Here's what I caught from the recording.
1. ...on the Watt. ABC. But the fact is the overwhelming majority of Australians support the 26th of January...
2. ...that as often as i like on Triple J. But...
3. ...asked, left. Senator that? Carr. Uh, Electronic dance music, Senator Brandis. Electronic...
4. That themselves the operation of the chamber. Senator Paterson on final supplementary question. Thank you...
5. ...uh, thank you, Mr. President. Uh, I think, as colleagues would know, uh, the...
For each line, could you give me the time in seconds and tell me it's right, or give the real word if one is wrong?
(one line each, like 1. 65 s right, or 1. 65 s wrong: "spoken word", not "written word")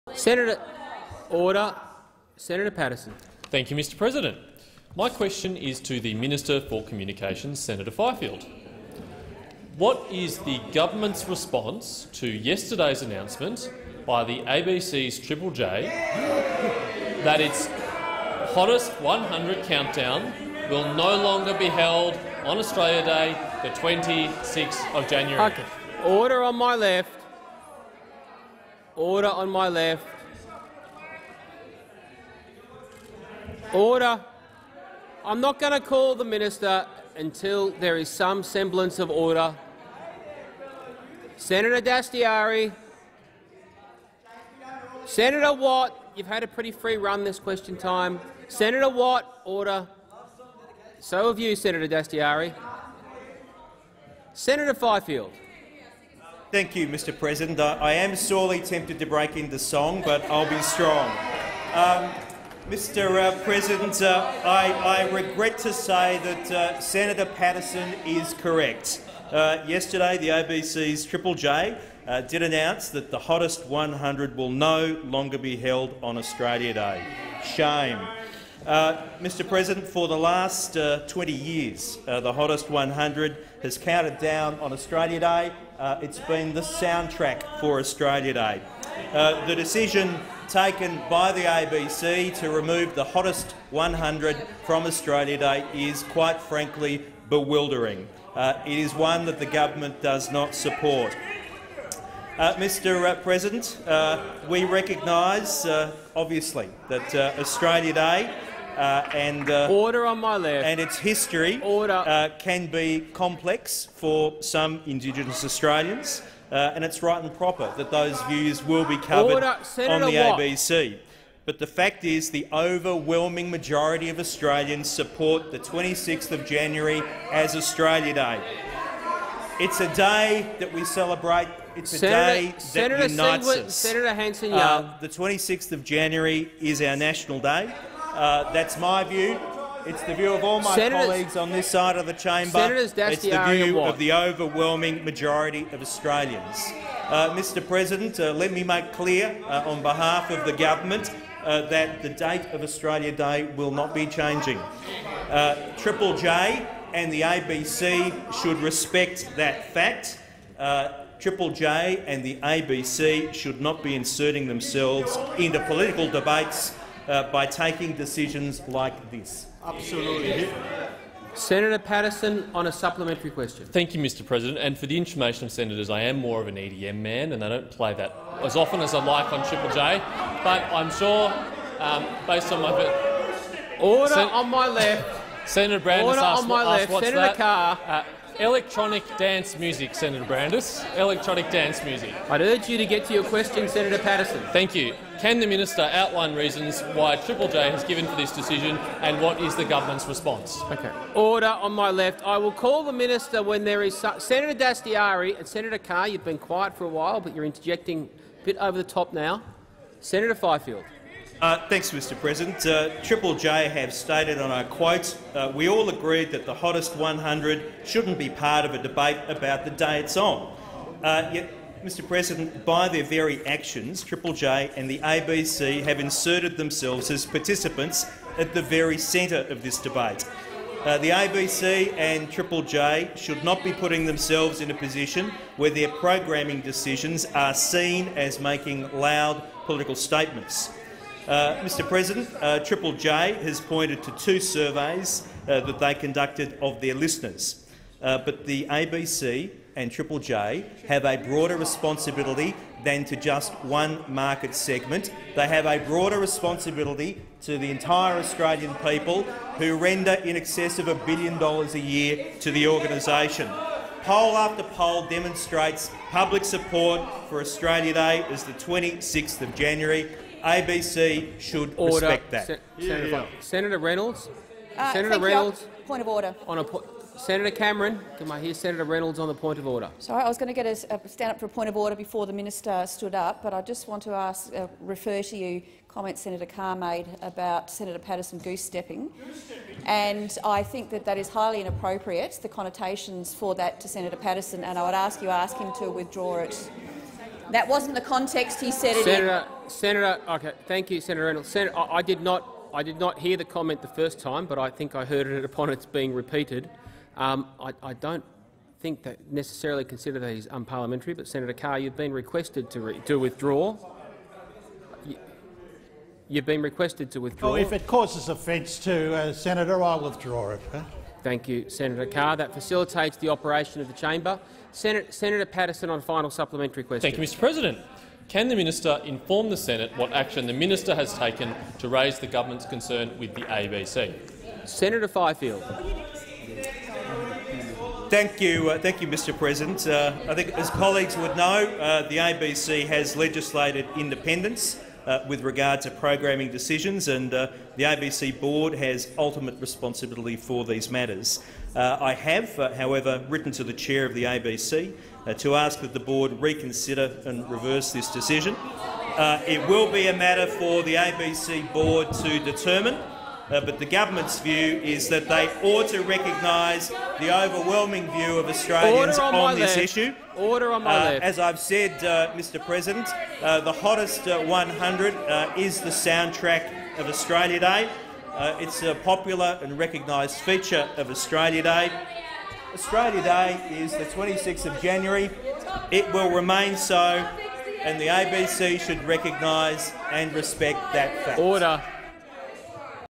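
1. 119 s right
2. 177 s right
3. 186 s right
4. 322 s wrong: "facilitates", not "themselves"
5. 338 s right.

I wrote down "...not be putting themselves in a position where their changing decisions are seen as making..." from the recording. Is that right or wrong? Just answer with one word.
wrong.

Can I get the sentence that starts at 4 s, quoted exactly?
My question is to the Minister for Communications, Senator Fifield.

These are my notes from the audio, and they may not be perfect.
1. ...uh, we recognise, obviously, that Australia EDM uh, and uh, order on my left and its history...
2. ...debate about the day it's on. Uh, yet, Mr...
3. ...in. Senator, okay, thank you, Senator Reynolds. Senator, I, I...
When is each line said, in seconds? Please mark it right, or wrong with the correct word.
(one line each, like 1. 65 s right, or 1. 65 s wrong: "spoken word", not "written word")
1. 103 s wrong: "Day", not "EDM"
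2. 218 s right
3. 299 s right.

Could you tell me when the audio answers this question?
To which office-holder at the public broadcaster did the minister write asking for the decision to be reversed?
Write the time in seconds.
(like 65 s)
353 s.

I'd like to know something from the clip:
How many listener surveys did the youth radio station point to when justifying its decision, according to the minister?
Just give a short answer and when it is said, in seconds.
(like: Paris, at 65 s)
2, at 244 s.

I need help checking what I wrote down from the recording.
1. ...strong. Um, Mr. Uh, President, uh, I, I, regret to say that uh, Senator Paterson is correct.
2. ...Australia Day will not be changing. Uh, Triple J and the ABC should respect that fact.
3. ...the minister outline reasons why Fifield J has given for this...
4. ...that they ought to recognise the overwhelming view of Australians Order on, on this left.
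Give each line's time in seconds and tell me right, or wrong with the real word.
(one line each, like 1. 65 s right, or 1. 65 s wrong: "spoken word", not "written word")
1. 60 s right
2. 152 s right
3. 195 s wrong: "Triple", not "Fifield"
4. 365 s right.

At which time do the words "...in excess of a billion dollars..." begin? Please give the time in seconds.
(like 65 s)
260 s.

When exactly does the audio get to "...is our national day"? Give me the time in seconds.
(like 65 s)
136 s.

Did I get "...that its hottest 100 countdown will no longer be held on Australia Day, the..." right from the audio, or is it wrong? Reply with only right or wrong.
right.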